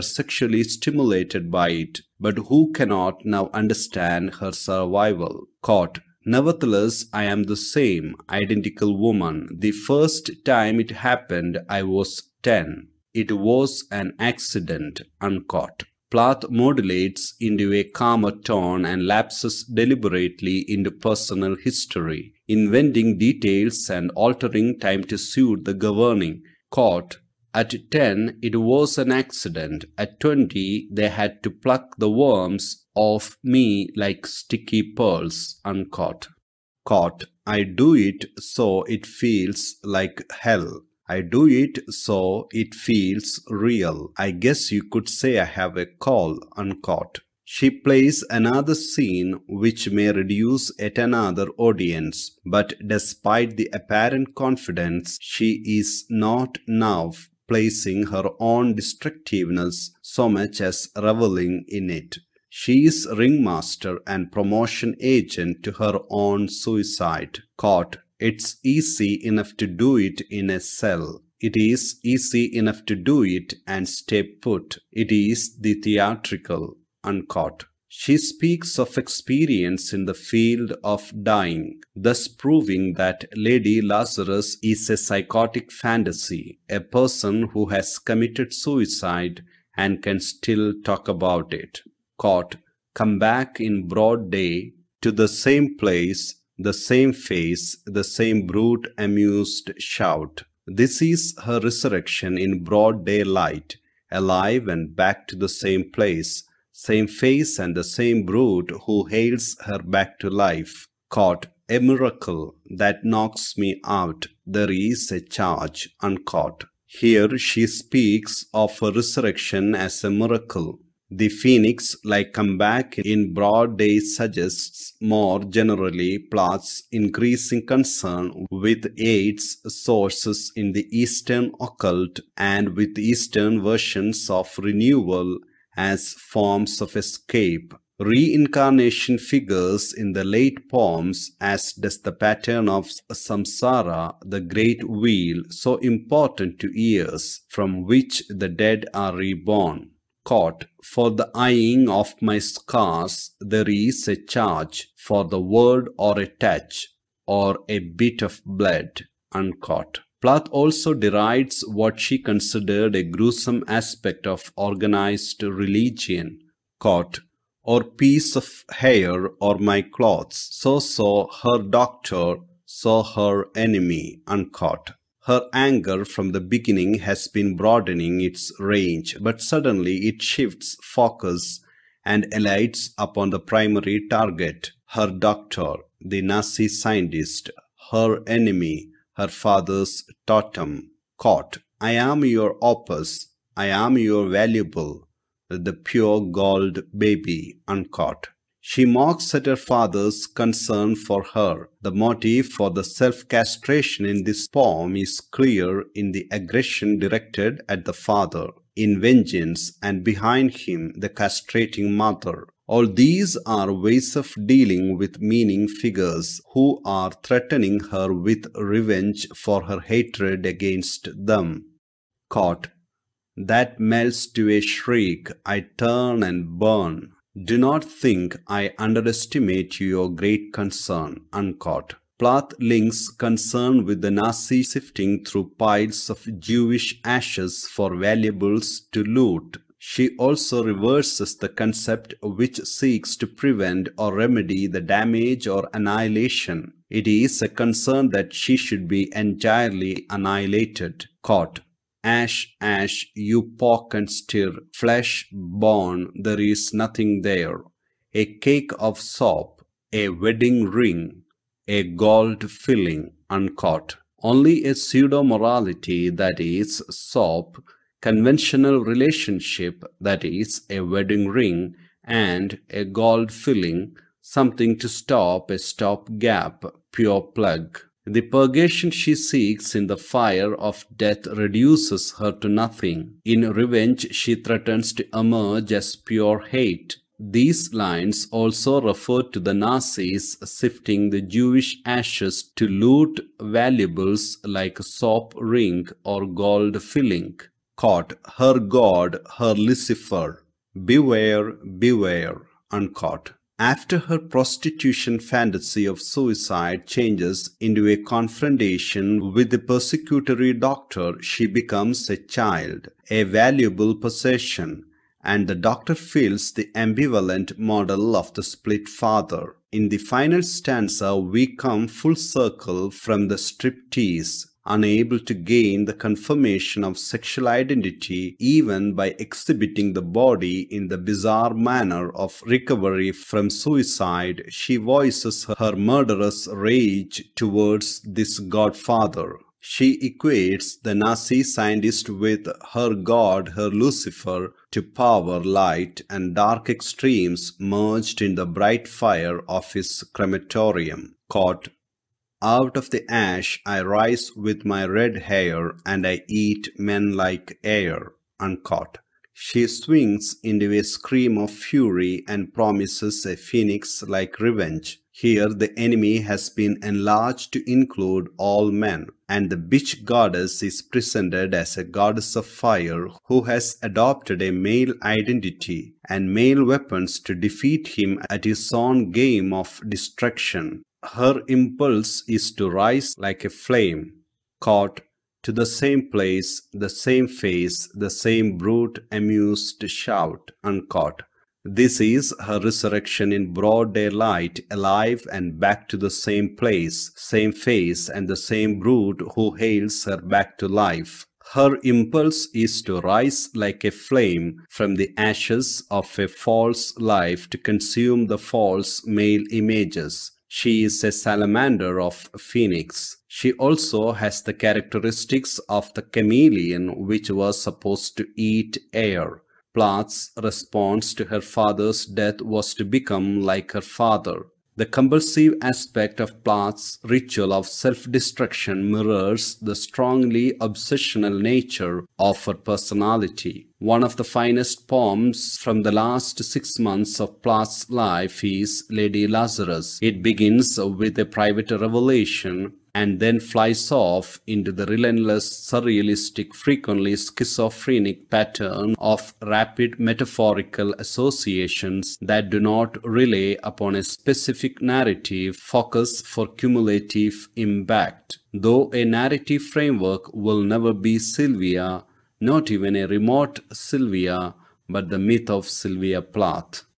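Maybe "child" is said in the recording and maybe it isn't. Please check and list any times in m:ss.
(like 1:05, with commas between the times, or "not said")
5:12.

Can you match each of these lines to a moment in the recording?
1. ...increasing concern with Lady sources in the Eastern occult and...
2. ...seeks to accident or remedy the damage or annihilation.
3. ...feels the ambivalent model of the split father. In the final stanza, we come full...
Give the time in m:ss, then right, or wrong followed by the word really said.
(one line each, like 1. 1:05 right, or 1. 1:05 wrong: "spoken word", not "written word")
1. 2:06 wrong: "AIDS", not "Lady"
2. 4:02 wrong: "prevent", not "accident"
3. 5:15 right.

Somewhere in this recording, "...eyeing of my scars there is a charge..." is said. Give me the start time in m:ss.
2:31.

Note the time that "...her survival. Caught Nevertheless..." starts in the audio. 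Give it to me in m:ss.
0:04.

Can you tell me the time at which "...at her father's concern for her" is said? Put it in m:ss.
3:19.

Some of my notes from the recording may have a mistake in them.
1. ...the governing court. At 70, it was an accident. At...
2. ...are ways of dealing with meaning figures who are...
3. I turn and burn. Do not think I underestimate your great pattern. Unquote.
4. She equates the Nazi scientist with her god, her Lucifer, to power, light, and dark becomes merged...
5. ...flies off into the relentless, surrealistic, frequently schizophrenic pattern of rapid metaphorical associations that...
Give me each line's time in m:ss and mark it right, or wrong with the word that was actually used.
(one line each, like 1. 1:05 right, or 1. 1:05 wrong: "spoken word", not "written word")
1. 0:25 wrong: "10", not "70"
2. 3:33 right
3. 3:45 wrong: "concern", not "pattern"
4. 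5:39 wrong: "extremes", not "becomes"
5. 7:23 right.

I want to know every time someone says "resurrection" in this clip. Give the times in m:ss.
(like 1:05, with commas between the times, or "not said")
1:41, 1:58, 6:32.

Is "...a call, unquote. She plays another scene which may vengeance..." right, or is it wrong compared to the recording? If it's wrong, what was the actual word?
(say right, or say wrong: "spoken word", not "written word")
wrong: "reduce", not "vengeance".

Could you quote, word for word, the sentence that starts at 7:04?
The compulsive aspect of Plath's ritual of self-destruction mirrors the strongly obsessional nature of her personality.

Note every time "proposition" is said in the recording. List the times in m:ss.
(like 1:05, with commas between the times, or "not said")
not said.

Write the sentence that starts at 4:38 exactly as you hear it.
The purgation she seeks in the fire of death reduces her to nothing.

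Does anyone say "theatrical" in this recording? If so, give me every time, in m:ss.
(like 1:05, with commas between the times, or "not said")
1:15.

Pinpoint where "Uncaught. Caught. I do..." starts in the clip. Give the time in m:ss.
0:35.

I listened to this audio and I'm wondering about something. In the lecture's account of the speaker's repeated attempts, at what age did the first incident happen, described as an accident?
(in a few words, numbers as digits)
10.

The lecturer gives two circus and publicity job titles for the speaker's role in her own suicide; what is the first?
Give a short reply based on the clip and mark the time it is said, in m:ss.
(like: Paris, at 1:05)
ringmaster, at 1:03.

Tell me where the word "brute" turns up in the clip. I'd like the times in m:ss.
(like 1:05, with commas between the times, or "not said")
1:38, 1:48, 6:28.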